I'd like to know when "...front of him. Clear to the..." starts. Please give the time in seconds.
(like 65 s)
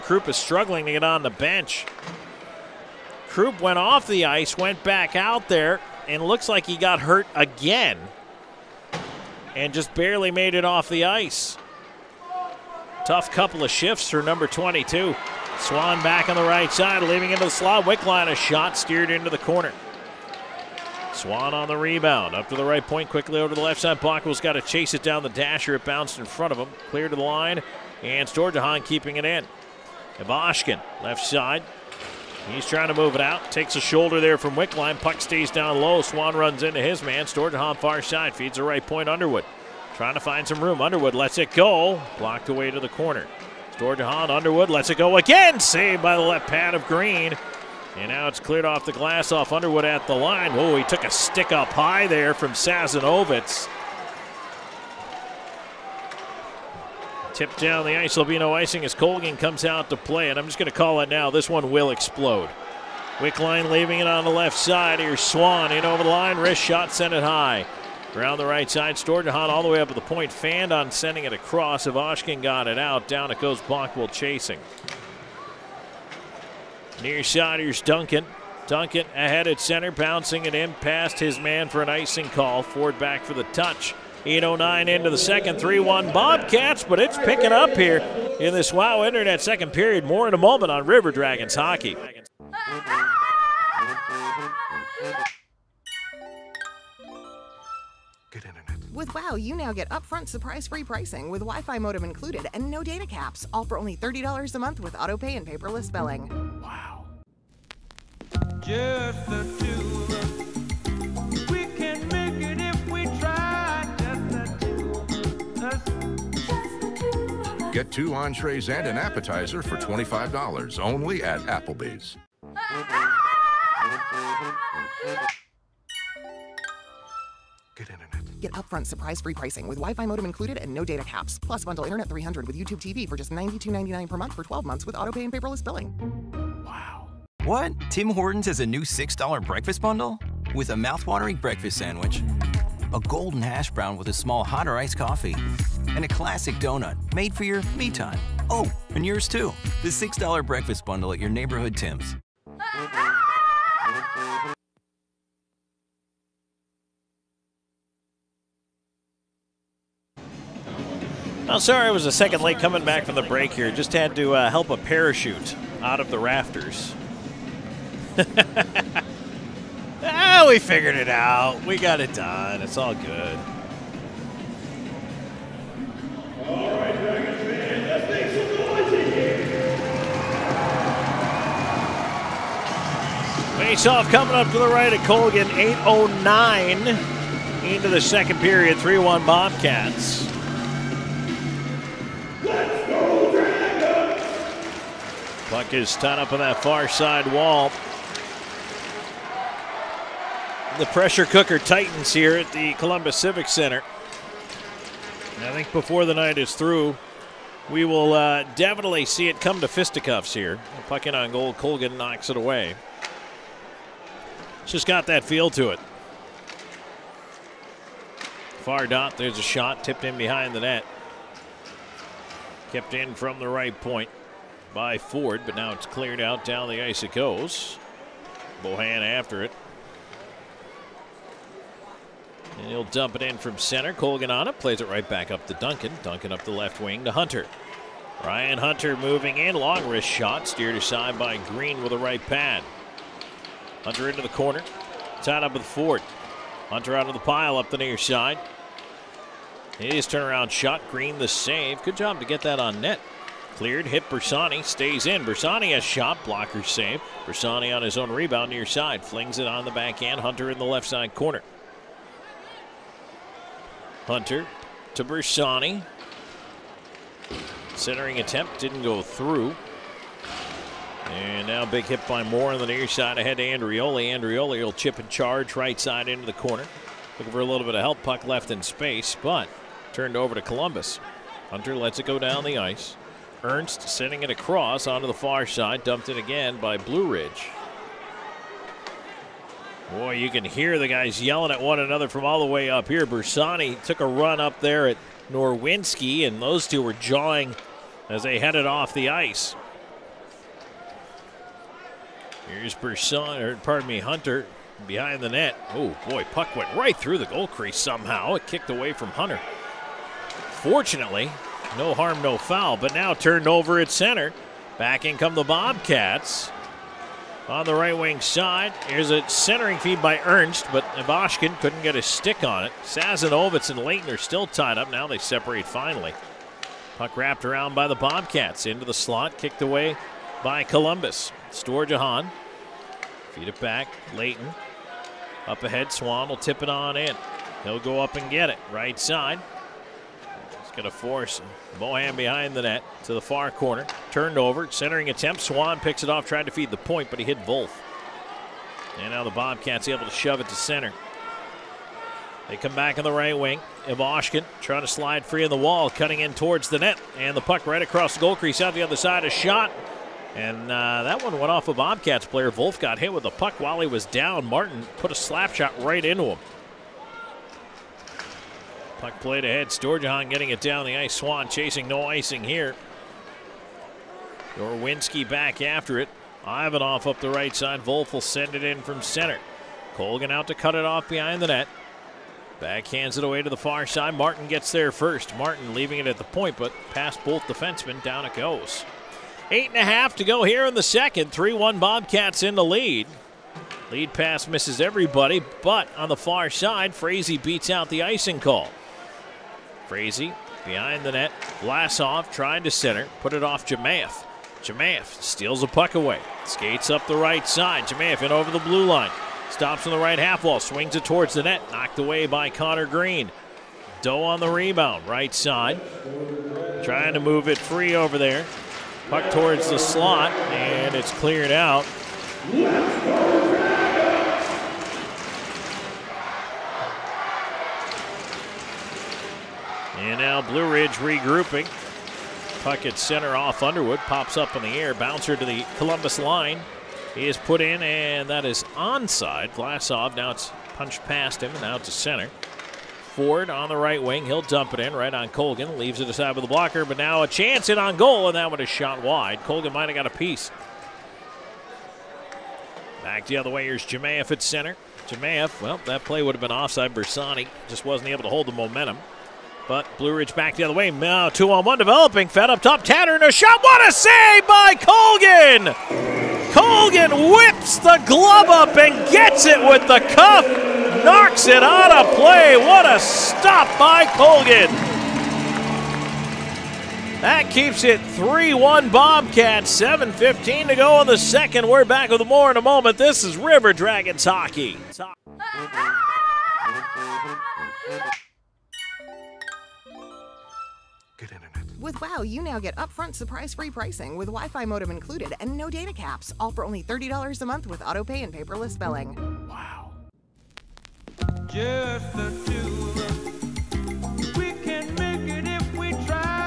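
26 s.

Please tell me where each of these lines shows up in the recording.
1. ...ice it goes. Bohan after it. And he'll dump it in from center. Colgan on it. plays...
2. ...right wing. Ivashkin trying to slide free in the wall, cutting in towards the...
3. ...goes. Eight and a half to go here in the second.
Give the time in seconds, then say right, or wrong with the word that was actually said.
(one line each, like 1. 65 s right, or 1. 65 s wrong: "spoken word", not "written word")
1. 226 s right
2. 353 s right
3. 388 s right.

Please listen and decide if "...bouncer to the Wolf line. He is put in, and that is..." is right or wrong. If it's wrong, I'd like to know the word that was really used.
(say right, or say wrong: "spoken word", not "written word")
wrong: "Columbus", not "Wolf".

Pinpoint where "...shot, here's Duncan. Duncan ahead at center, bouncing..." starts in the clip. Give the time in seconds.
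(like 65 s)
77 s.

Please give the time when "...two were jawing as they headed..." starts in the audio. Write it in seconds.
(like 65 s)
296 s.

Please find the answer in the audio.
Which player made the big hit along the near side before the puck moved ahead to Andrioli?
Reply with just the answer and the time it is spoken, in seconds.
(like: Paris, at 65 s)
Moore, at 272 s.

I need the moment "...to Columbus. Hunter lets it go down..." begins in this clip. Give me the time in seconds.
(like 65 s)
280 s.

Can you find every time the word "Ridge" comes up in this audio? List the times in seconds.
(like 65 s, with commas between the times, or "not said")
287 s, 430 s, 460 s.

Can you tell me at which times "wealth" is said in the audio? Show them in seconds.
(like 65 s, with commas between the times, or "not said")
not said.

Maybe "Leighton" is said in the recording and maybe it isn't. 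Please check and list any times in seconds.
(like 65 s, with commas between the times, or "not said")
323 s, 334 s.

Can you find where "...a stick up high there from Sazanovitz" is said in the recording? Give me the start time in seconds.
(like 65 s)
51 s.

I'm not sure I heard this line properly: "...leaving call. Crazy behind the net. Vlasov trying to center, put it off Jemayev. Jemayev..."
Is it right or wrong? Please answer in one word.
wrong.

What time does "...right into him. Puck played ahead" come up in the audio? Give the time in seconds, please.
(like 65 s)
365 s.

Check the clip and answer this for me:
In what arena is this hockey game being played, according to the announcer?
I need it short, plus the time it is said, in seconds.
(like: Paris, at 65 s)
Columbus Civic Center, at 202 s.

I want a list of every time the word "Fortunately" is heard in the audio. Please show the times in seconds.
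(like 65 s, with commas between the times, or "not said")
310 s.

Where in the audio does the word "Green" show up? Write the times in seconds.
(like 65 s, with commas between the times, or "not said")
46 s, 241 s, 250 s, 412 s.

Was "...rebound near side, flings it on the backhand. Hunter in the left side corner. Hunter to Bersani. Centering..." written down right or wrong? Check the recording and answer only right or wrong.
right.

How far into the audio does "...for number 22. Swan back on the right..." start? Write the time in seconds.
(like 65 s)
14 s.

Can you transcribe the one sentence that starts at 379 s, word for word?
Colgan out to cut it off behind the net.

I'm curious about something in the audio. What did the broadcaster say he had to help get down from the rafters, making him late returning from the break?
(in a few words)
A parachute.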